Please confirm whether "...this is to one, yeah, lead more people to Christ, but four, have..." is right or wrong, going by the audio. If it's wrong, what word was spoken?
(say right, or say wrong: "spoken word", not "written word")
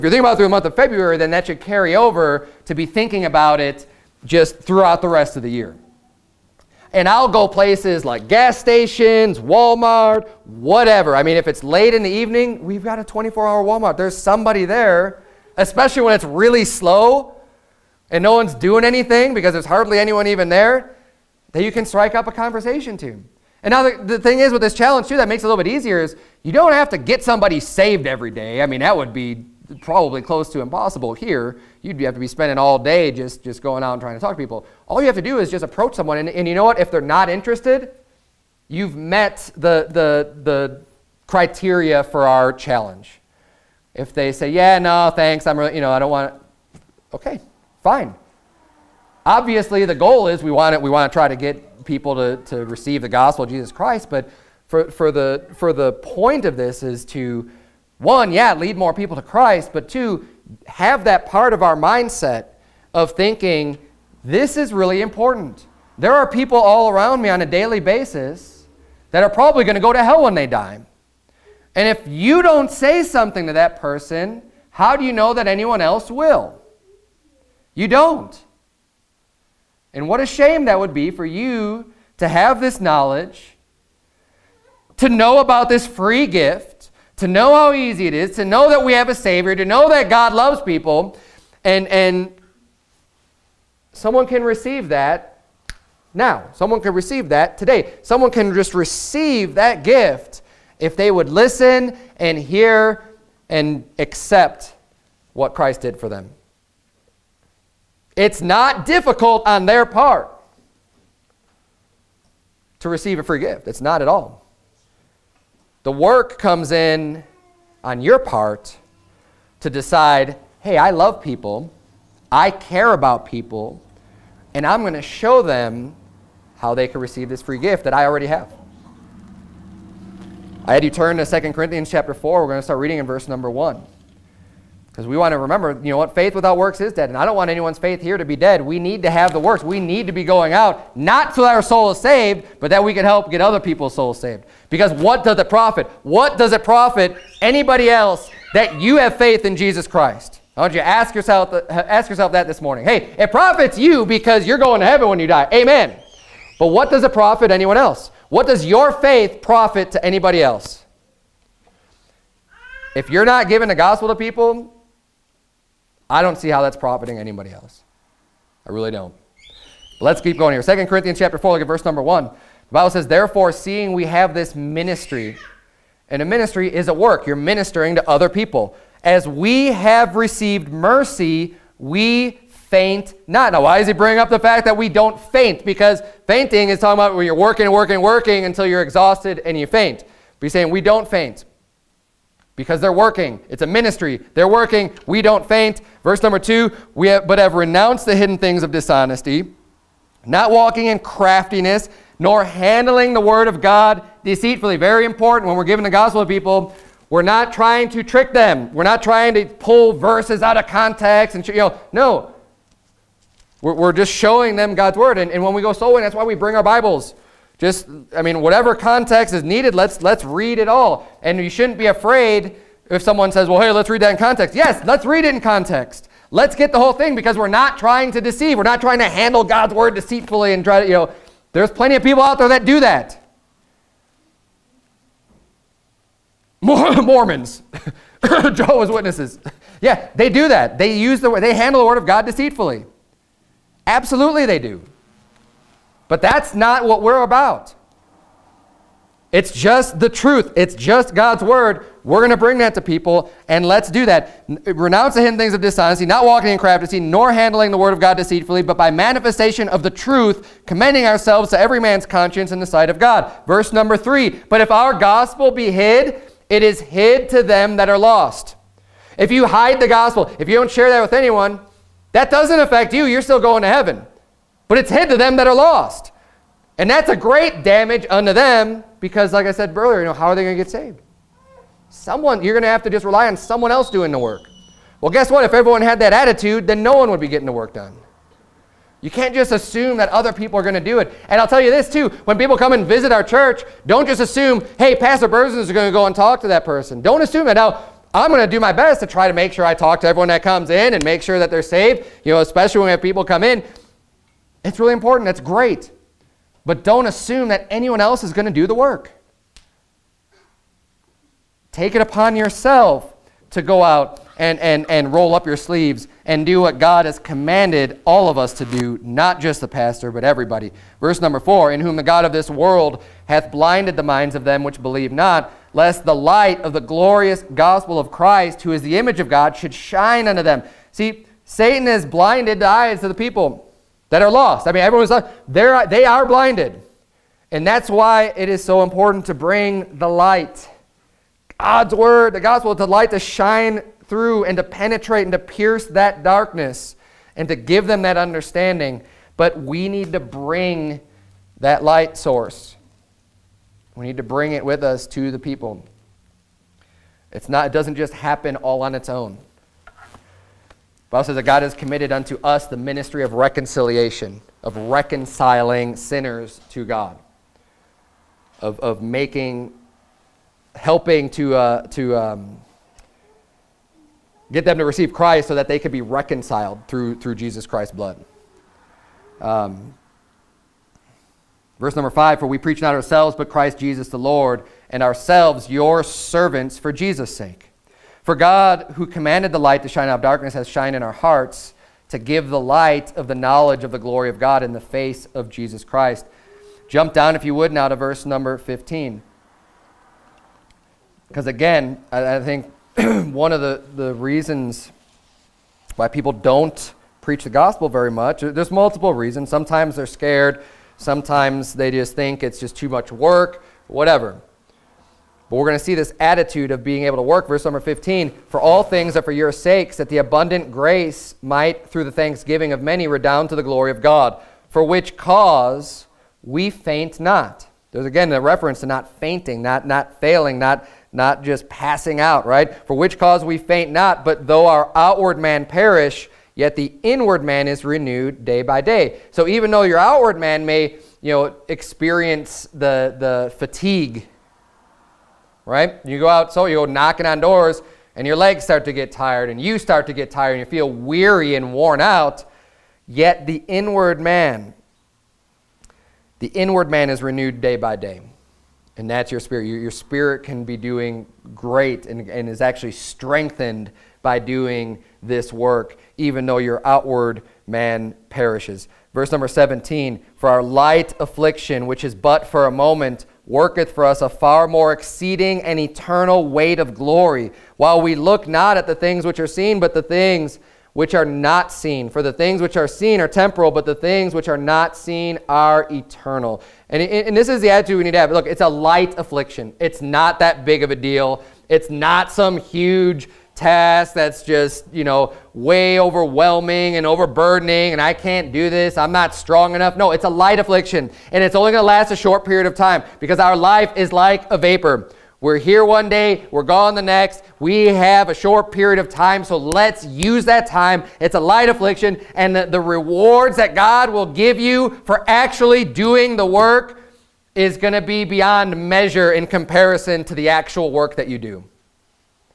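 wrong: "two", not "four".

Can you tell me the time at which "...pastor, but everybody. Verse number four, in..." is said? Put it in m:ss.
5:19.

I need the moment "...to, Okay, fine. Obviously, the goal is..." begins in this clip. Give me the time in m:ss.
0:46.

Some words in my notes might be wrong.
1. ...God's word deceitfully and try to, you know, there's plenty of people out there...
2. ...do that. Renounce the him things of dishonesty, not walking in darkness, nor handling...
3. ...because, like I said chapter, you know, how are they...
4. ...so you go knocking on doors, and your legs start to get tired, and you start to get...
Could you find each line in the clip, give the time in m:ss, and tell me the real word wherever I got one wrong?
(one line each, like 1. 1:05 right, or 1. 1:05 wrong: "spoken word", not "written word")
1. 3:49 right
2. 4:13 wrong: "craftiness", not "darkness"
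3. 4:38 wrong: "earlier", not "chapter"
4. 7:26 right.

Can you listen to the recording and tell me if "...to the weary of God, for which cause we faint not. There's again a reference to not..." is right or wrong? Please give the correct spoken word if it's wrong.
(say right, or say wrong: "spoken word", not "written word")
wrong: "glory", not "weary".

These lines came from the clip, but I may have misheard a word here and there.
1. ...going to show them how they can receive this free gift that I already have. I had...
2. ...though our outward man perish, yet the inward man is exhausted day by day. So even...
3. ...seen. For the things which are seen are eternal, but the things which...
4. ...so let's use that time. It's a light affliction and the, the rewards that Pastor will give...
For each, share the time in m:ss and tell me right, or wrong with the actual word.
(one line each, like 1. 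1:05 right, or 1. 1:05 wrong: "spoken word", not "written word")
1. 2:04 right
2. 7:14 wrong: "renewed", not "exhausted"
3. 8:01 wrong: "temporal", not "eternal"
4. 8:29 wrong: "God", not "Pastor".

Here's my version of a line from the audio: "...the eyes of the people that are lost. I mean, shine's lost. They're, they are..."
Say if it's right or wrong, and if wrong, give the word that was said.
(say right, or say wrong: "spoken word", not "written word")
wrong: "everyone", not "shine".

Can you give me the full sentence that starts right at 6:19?
Um, verse number five For we preach not ourselves, but Christ Jesus the Lord, and ourselves your servants for Jesus' sake.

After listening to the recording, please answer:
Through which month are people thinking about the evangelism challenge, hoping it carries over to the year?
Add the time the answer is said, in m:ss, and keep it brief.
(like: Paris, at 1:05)
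February, at 0:00.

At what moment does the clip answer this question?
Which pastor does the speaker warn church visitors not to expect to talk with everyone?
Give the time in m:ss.
4:54.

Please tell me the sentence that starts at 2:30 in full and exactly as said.
I want you to ask yourself, ask yourself that this morning.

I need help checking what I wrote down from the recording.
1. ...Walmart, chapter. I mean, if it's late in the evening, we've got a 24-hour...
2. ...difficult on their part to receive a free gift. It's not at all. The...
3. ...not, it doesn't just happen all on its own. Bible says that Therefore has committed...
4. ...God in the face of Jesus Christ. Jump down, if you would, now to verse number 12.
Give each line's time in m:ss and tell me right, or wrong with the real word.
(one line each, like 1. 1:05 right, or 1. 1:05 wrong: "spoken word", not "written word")
1. 0:09 wrong: "whatever", not "chapter"
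2. 1:48 right
3. 5:57 wrong: "God", not "Therefore"
4. 6:34 wrong: "15", not "12".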